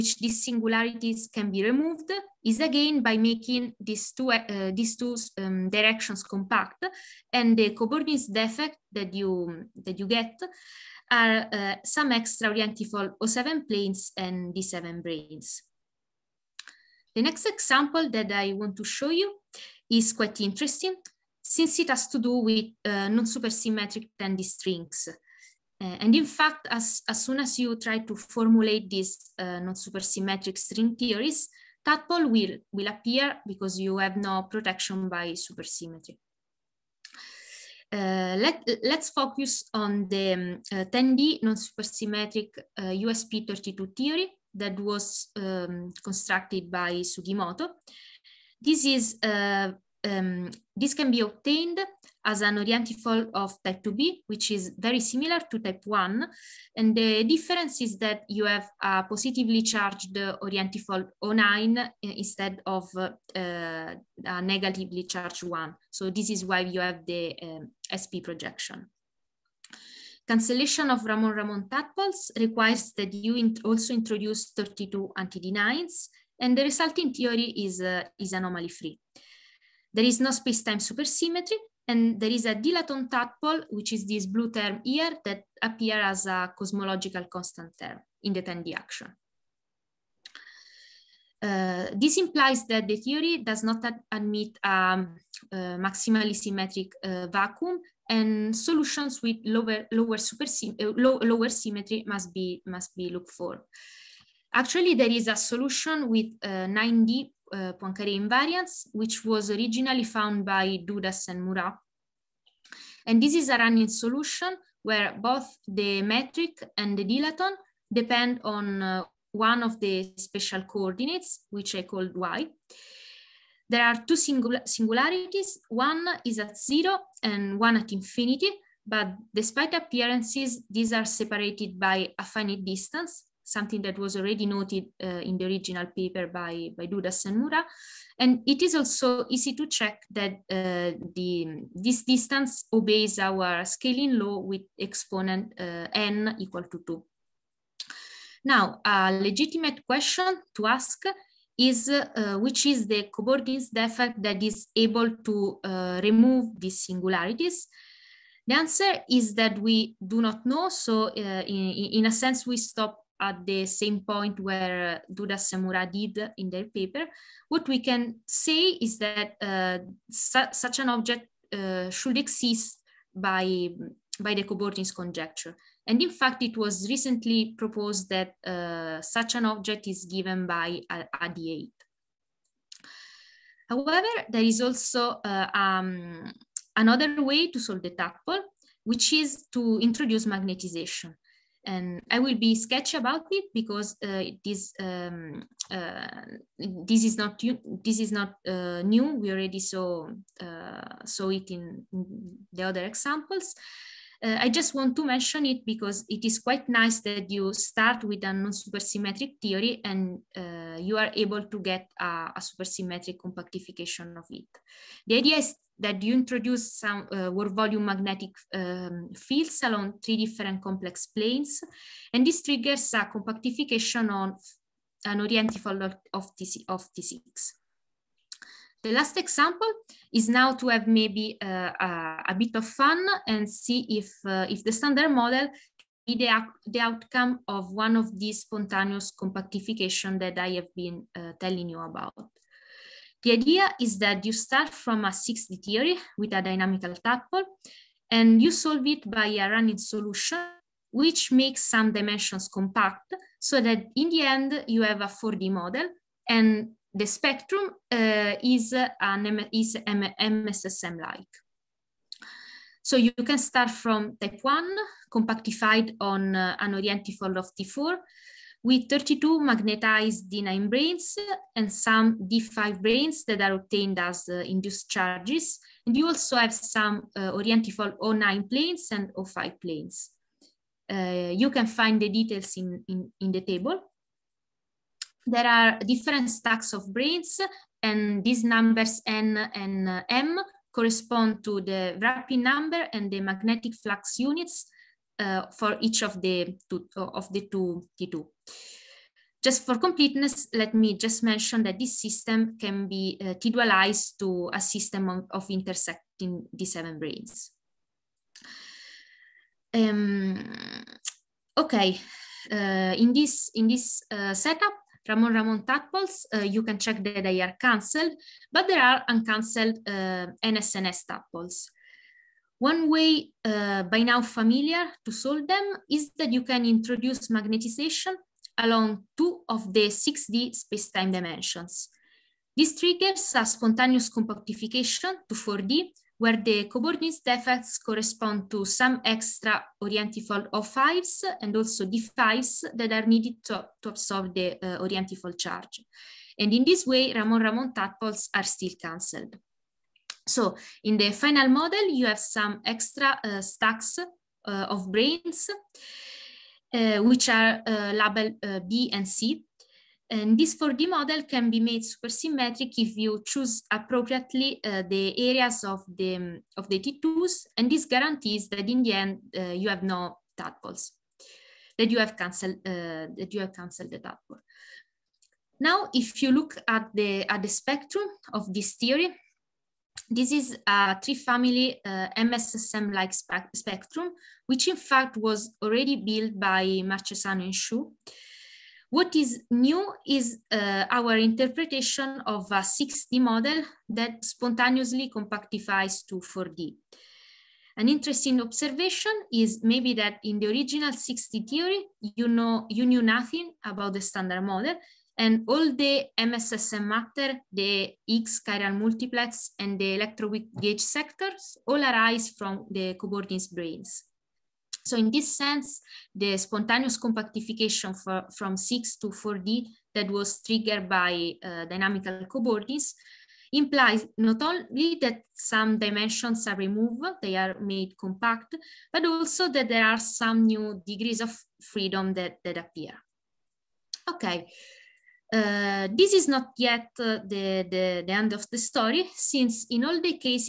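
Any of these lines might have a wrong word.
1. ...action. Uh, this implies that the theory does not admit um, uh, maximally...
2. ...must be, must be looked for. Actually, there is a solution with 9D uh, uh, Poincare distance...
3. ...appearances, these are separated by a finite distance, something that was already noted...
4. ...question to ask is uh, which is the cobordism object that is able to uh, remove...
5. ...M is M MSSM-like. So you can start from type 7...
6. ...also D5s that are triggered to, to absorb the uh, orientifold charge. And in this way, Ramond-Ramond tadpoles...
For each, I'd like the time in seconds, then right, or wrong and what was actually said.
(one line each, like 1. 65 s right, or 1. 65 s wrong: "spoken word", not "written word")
1. 88 s right
2. 102 s wrong: "invariance", not "distance"
3. 129 s right
4. 149 s wrong: "defect", not "object"
5. 259 s wrong: "1", not "7"
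6. 341 s wrong: "needed", not "triggered".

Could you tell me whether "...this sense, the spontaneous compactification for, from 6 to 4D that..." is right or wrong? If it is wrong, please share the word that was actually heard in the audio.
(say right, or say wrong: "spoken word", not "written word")
right.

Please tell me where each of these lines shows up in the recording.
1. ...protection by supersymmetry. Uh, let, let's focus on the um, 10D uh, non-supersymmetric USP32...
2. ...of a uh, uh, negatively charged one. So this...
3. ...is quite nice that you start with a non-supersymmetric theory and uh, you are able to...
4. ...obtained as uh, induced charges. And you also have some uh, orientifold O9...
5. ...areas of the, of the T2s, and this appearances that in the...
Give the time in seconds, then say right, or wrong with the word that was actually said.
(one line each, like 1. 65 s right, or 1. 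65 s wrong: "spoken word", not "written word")
1. 34 s right
2. 62 s right
3. 206 s right
4. 273 s right
5. 365 s wrong: "guarantees", not "appearances".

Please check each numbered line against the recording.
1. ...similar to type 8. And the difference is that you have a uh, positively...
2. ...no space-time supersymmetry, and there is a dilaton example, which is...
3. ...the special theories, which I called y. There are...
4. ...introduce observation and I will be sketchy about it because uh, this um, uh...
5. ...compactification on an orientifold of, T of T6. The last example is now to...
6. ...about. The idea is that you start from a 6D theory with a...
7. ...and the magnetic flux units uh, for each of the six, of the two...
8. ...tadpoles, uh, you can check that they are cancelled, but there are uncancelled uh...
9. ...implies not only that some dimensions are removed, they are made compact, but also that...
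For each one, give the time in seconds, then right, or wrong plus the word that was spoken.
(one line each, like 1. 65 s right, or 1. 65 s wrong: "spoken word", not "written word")
1. 55 s wrong: "1", not "8"
2. 80 s wrong: "tadpole", not "example"
3. 119 s wrong: "coordinates", not "theories"
4. 189 s wrong: "magnetization", not "observation"
5. 223 s right
6. 241 s right
7. 292 s wrong: "two", not "six"
8. 315 s right
9. 423 s right.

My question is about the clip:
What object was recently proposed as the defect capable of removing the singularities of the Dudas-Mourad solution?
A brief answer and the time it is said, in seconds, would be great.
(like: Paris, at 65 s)
a D8, at 181 s.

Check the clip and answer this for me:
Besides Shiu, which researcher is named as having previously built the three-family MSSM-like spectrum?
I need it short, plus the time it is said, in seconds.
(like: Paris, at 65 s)
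Marchesano, at 386 s.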